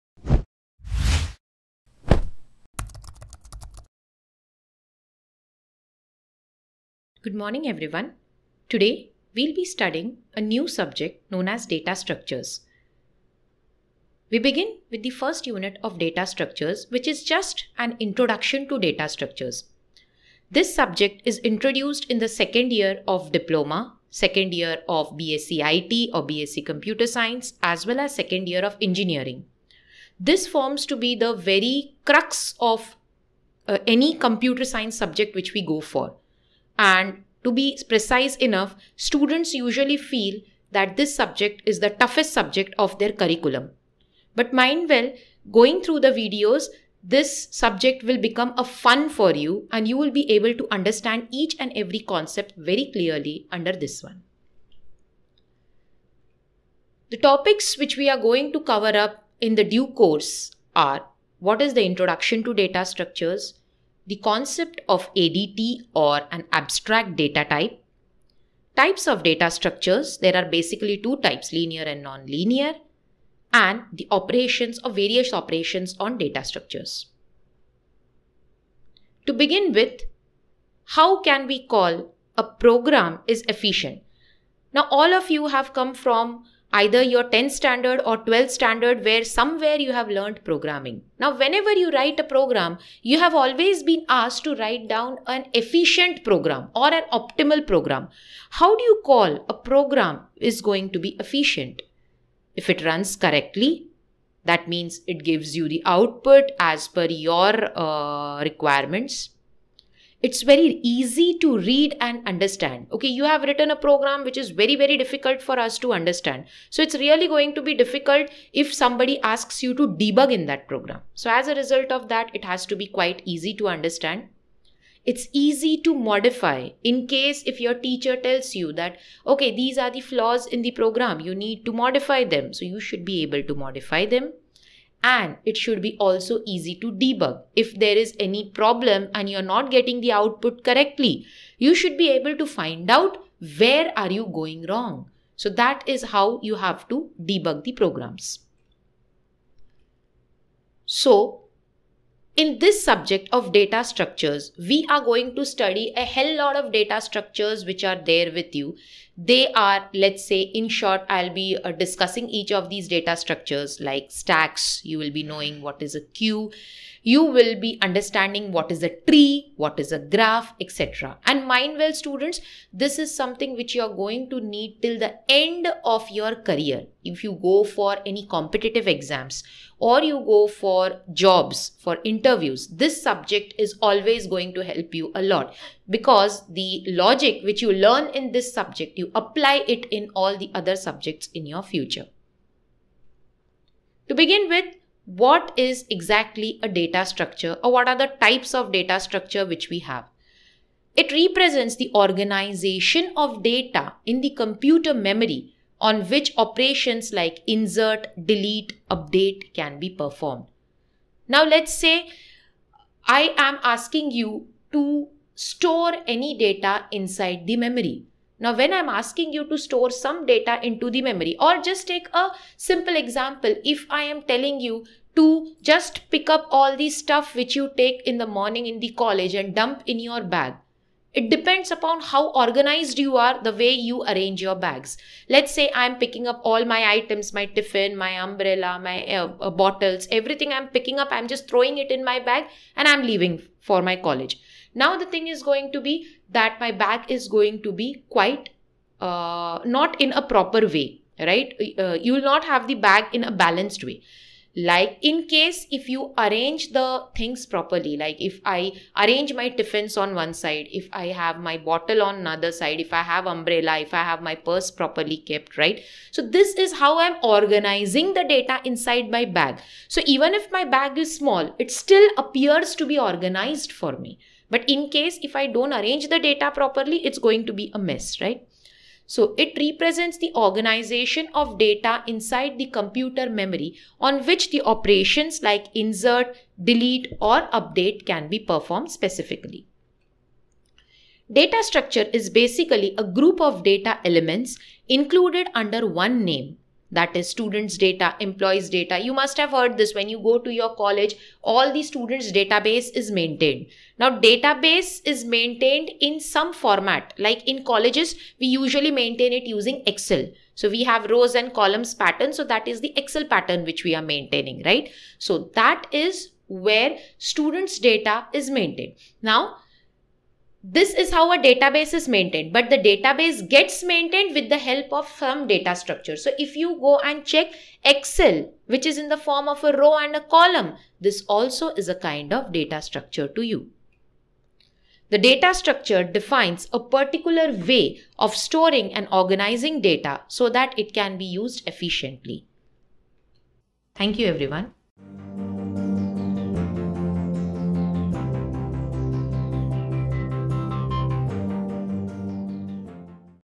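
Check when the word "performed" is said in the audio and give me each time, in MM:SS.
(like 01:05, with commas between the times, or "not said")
03:29, 04:48.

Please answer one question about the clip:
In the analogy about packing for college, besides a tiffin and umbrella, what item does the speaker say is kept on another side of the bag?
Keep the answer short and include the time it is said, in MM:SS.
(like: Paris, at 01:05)
bottle, at 04:21.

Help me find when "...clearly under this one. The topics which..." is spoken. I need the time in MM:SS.
00:52.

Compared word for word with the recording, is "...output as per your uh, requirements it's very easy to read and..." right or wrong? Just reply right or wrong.
right.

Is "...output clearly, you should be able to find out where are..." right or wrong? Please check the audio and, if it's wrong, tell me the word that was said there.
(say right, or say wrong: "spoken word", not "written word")
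wrong: "correctly", not "clearly".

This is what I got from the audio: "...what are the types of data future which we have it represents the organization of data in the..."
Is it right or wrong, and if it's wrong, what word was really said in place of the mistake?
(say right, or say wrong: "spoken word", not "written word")
wrong: "structure", not "future".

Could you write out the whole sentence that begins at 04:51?
Data structure is basically a group of data elements included under one name that is students data, employees data.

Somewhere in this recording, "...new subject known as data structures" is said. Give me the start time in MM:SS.
00:10.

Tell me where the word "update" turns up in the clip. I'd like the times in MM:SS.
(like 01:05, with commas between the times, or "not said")
03:28, 04:47.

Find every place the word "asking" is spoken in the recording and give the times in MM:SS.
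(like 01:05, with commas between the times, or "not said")
03:33, 03:38.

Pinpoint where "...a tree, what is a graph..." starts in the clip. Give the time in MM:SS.
02:48.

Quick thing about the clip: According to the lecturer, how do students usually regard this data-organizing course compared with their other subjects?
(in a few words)
the toughest subject.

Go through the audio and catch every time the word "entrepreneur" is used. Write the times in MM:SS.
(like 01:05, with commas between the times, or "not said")
not said.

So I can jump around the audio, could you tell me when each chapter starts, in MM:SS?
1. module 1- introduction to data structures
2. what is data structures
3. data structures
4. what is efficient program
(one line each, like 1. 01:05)
1. 00:56
2. 03:13
3. 02:28
4. 01:19.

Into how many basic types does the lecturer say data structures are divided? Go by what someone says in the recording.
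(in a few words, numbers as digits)
2.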